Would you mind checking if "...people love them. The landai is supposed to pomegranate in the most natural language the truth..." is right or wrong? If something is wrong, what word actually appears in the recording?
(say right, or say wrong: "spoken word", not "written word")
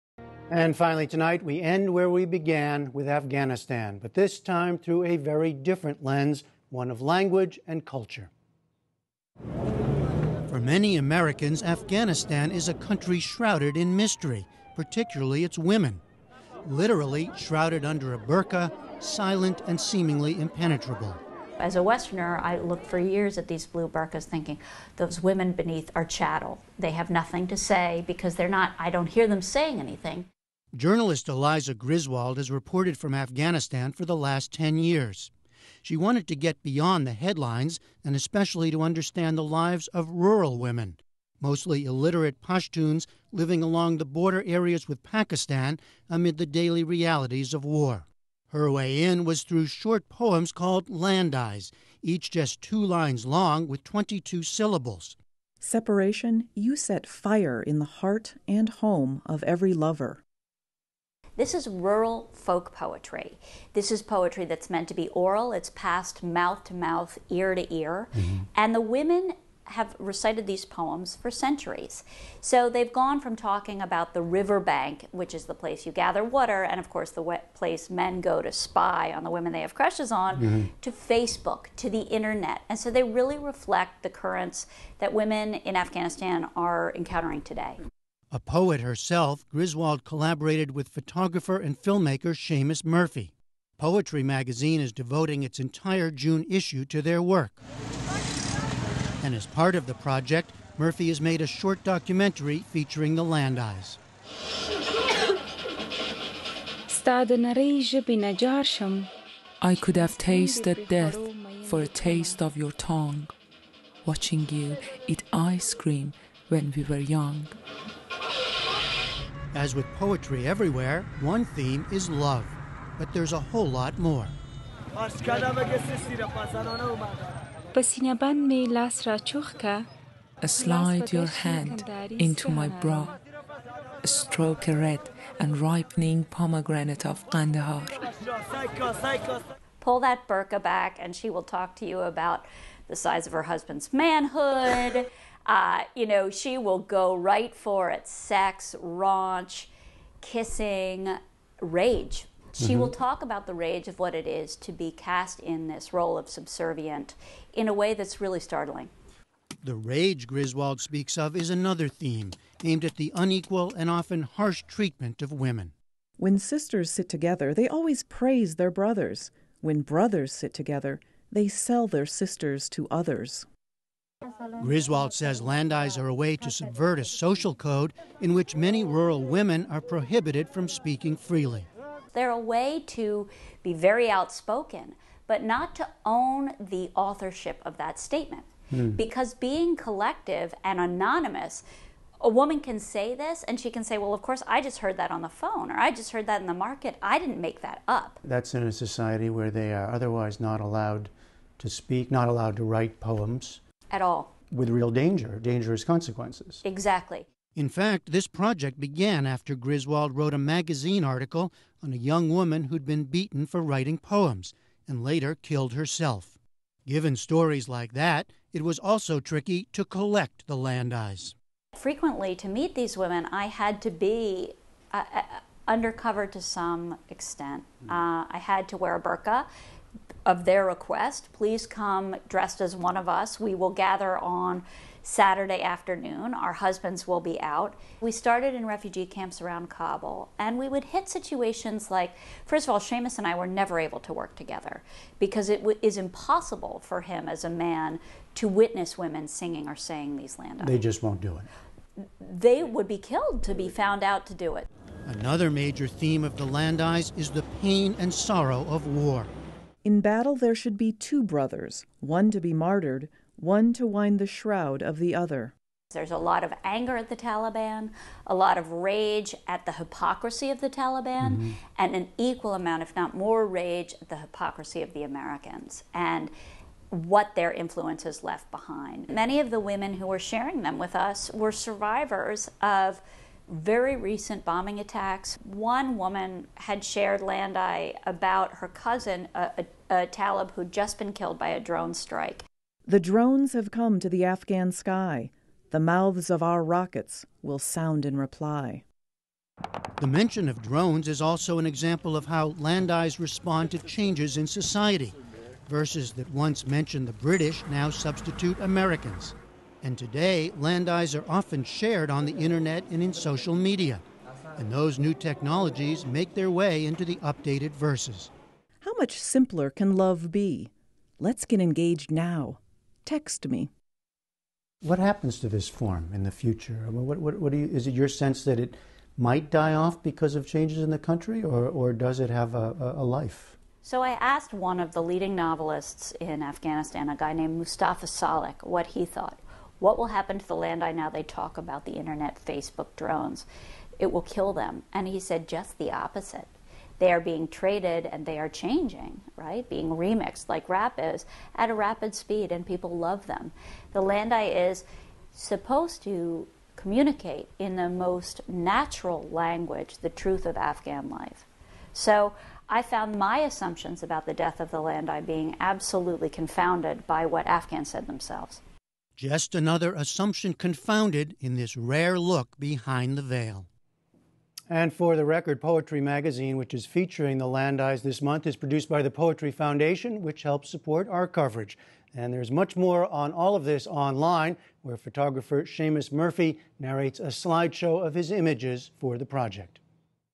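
wrong: "communicate", not "pomegranate".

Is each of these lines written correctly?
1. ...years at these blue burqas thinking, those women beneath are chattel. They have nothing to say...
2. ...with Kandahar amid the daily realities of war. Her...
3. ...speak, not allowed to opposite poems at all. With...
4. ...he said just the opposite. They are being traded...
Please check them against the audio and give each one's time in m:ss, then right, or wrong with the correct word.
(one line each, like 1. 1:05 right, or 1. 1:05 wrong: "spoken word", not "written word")
1. 0:22 right
2. 0:44 wrong: "Pakistan", not "Kandahar"
3. 3:21 wrong: "write", not "opposite"
4. 5:45 right.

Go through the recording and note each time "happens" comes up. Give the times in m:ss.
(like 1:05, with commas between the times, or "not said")
5:24, 5:40.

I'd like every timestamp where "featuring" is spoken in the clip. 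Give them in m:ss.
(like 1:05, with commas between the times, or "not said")
1:42, 6:16.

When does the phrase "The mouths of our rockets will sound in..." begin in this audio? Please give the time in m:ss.
4:55.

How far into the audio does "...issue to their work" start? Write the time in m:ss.
1:36.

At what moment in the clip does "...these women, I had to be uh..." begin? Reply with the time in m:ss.
3:42.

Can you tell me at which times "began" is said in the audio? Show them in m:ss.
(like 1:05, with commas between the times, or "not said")
0:02, 3:28.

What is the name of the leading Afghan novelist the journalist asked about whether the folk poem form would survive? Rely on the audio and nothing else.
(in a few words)
Mustafa Salik.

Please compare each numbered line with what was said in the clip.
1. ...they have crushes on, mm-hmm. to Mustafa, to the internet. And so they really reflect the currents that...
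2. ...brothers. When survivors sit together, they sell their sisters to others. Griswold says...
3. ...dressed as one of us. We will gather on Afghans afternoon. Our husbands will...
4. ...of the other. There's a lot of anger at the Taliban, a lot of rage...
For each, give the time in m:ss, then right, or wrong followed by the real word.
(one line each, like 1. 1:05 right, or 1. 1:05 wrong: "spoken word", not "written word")
1. 1:19 wrong: "Facebook", not "Mustafa"
2. 2:48 wrong: "brothers", not "survivors"
3. 3:52 wrong: "Saturday", not "Afghans"
4. 4:24 right.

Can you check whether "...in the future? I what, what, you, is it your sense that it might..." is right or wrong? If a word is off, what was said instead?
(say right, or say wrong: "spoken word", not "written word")
right.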